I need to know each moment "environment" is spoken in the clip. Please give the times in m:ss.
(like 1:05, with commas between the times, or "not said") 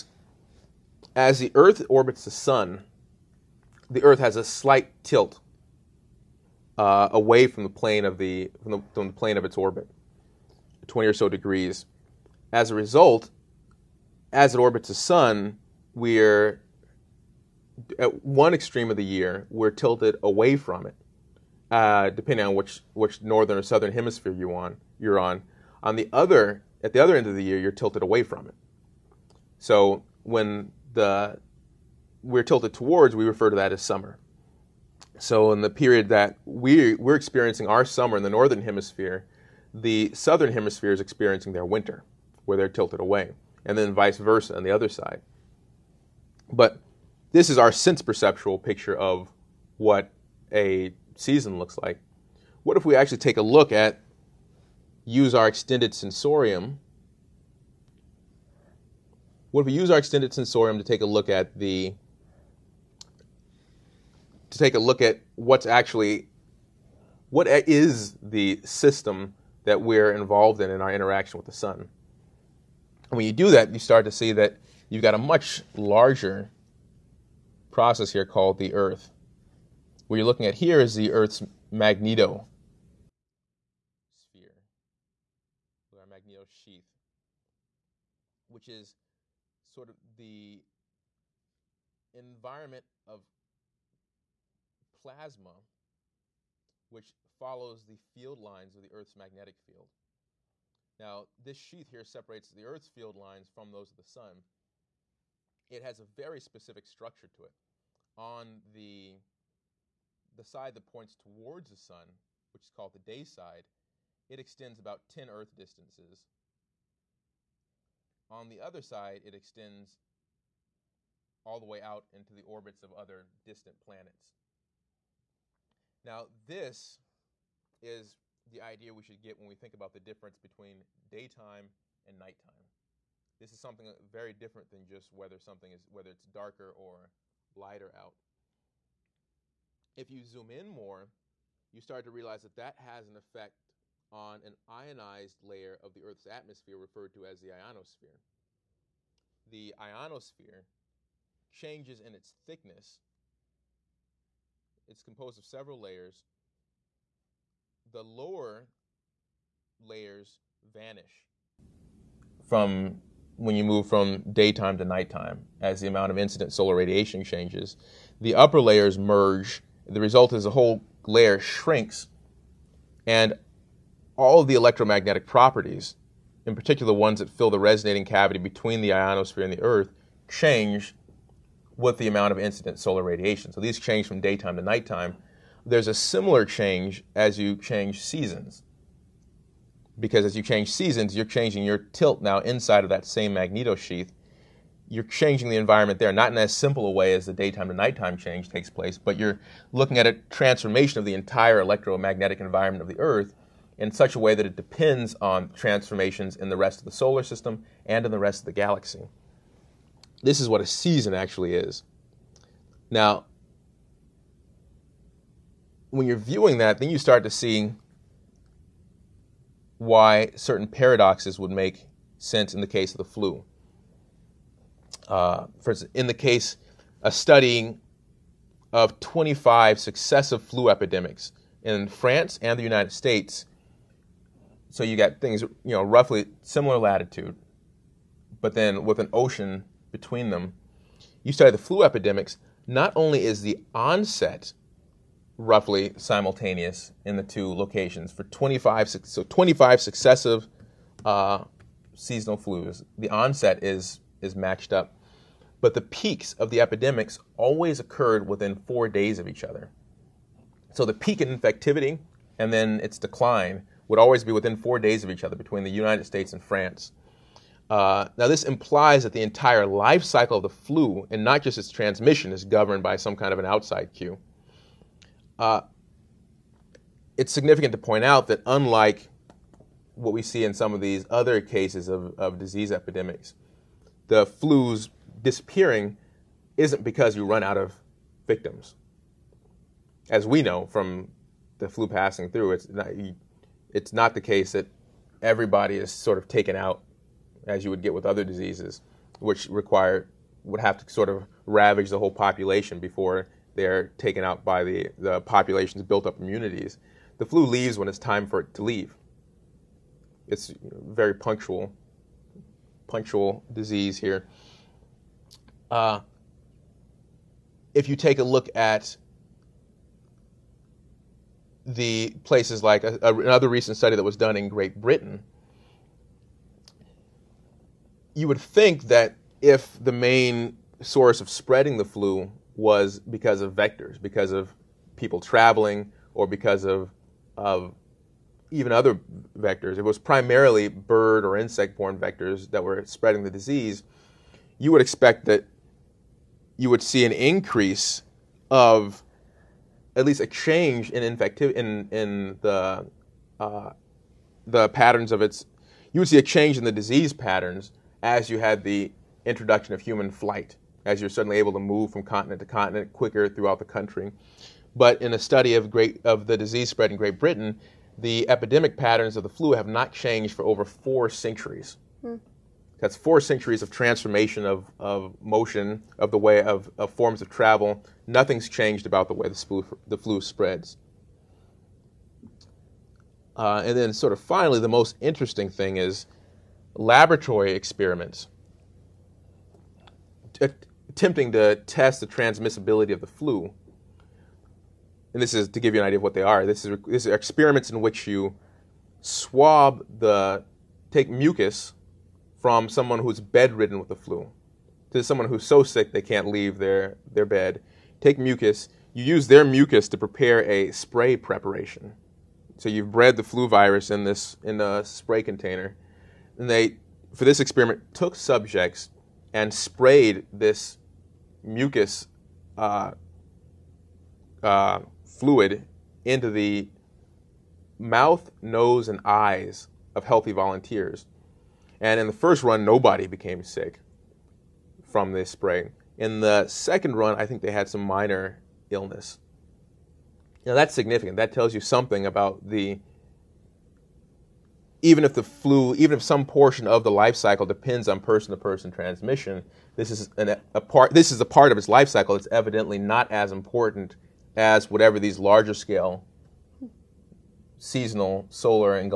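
1:32, 3:15, 3:22.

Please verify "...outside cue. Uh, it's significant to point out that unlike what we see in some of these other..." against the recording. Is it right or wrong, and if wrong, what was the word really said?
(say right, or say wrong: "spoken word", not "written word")
right.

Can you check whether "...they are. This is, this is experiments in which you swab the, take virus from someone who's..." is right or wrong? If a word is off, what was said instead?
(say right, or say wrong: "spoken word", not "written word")
wrong: "mucus", not "virus".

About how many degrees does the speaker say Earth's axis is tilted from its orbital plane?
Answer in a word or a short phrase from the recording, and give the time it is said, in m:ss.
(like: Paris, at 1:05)
20, at 0:10.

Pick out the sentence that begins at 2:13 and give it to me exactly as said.
This is something very different than just whether something is whether it's darker or lighter out.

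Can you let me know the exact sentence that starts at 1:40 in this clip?
Now, this sheath here separates the Earth's field lines from those of the Sun.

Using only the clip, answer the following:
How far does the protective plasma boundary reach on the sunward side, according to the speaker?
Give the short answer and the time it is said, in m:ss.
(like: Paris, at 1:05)
10 Earth distances, at 1:55.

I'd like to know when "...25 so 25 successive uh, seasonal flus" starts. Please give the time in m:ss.
4:08.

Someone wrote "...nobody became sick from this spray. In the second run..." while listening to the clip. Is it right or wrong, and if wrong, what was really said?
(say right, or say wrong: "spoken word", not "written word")
right.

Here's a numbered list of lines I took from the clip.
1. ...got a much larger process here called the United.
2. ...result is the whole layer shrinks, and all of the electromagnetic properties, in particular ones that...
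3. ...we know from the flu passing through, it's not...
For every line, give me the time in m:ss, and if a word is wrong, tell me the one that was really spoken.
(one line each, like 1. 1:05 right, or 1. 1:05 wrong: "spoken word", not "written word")
1. 1:15 wrong: "Earth", not "United"
2. 2:50 right
3. 4:50 right.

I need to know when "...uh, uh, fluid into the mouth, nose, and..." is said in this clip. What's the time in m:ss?
7:02.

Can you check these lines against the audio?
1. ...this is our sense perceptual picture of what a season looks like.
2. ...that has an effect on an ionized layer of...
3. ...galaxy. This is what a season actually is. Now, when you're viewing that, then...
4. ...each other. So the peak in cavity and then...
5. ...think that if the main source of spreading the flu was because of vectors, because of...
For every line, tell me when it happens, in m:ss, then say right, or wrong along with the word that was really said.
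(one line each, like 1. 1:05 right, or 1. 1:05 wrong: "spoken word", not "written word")
1. 0:47 right
2. 2:22 right
3. 3:28 right
4. 4:19 wrong: "infectivity", not "cavity"
5. 5:28 right.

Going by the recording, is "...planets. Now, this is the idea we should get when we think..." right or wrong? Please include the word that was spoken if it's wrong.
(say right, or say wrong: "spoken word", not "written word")
right.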